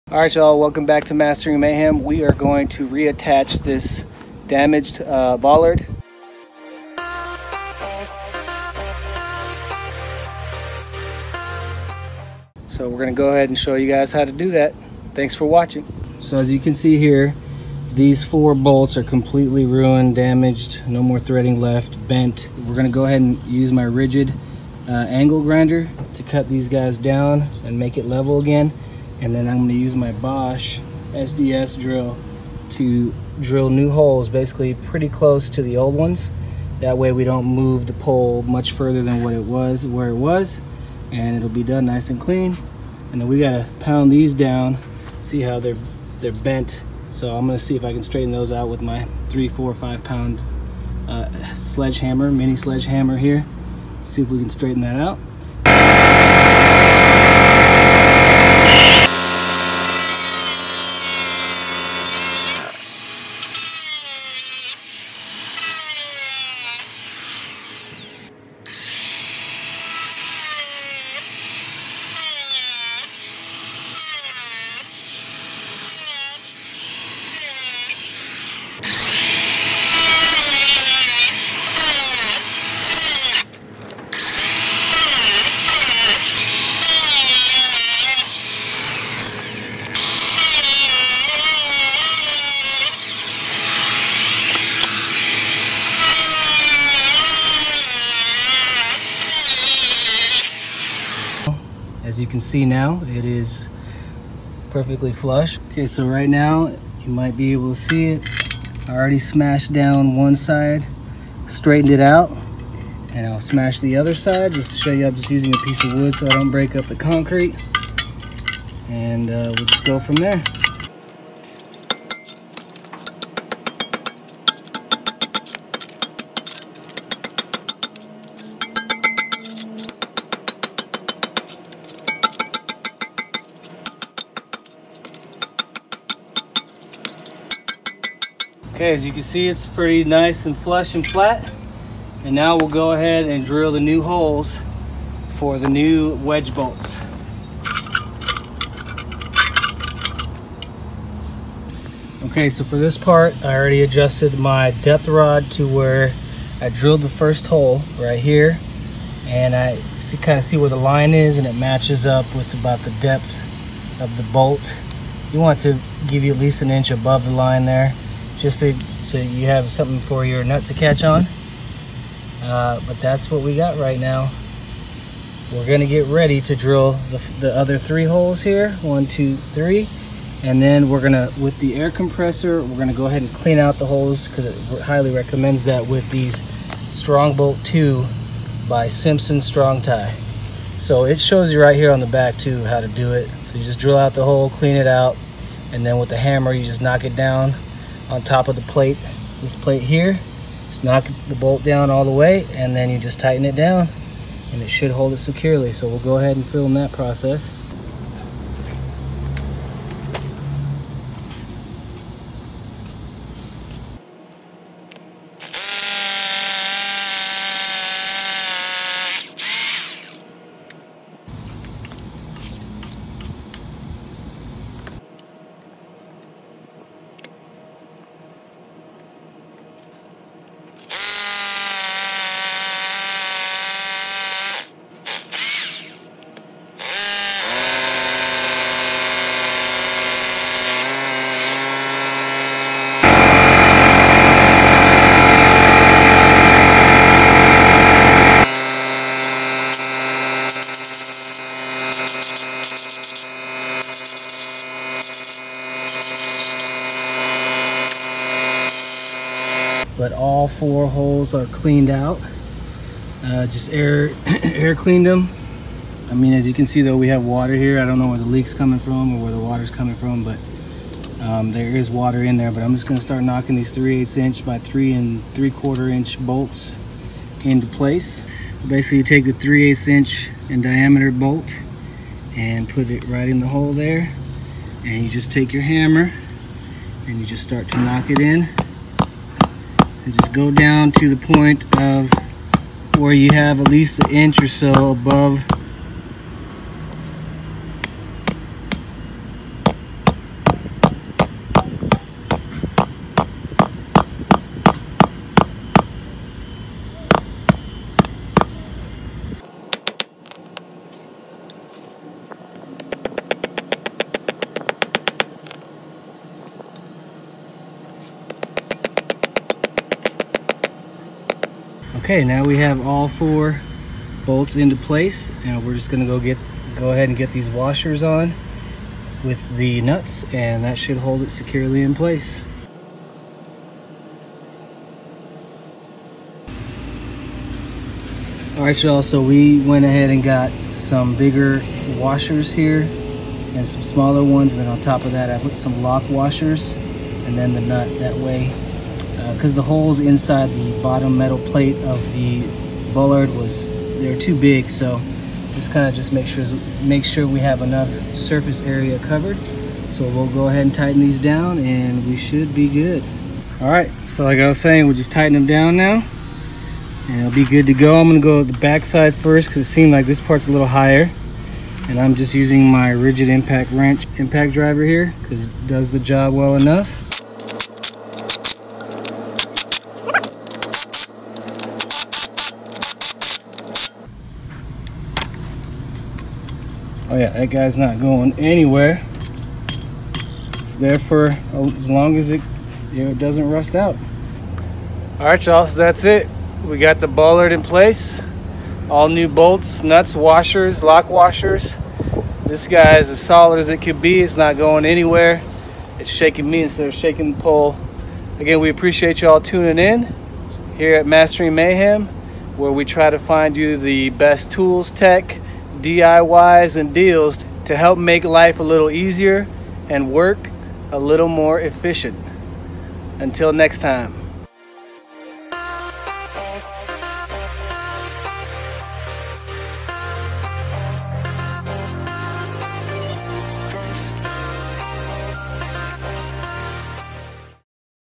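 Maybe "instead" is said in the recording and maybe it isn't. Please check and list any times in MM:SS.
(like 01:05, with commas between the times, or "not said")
06:46.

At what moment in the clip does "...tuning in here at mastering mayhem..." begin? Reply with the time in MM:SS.
06:49.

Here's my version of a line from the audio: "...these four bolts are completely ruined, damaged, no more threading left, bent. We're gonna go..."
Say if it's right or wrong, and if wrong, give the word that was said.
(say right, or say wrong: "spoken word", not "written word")
right.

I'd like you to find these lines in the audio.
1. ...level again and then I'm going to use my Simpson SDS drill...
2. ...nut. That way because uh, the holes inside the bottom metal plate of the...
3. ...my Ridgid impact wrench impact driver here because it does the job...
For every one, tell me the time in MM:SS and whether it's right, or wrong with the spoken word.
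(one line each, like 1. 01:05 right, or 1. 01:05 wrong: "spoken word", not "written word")
1. 00:28 wrong: "Bosch", not "Simpson"
2. 05:47 right
3. 06:12 right.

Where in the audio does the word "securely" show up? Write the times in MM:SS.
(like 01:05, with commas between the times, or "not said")
03:25, 05:31.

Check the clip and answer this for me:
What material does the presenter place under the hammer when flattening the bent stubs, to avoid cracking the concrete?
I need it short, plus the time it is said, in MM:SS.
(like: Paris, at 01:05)
a piece of wood, at 01:55.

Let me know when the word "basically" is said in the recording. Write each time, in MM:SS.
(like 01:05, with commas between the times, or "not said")
00:34, 04:38.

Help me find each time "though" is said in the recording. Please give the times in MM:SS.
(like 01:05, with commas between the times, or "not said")
04:26.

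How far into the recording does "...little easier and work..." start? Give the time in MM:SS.
06:58.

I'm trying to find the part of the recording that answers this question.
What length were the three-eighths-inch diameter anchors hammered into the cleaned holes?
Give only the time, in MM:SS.
04:34.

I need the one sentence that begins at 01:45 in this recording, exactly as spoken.
Okay, so right now, you might be able to see it.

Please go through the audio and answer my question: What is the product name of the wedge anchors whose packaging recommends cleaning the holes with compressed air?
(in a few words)
Strongbolt 2.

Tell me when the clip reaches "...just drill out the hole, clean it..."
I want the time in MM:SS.
03:13.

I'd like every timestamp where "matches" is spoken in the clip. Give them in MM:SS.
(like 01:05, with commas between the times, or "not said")
02:41.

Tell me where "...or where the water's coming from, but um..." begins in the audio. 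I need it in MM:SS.
04:29.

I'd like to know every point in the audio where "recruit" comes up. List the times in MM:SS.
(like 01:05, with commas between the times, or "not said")
not said.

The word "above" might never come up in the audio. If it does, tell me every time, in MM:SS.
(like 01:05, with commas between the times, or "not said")
02:46, 04:54.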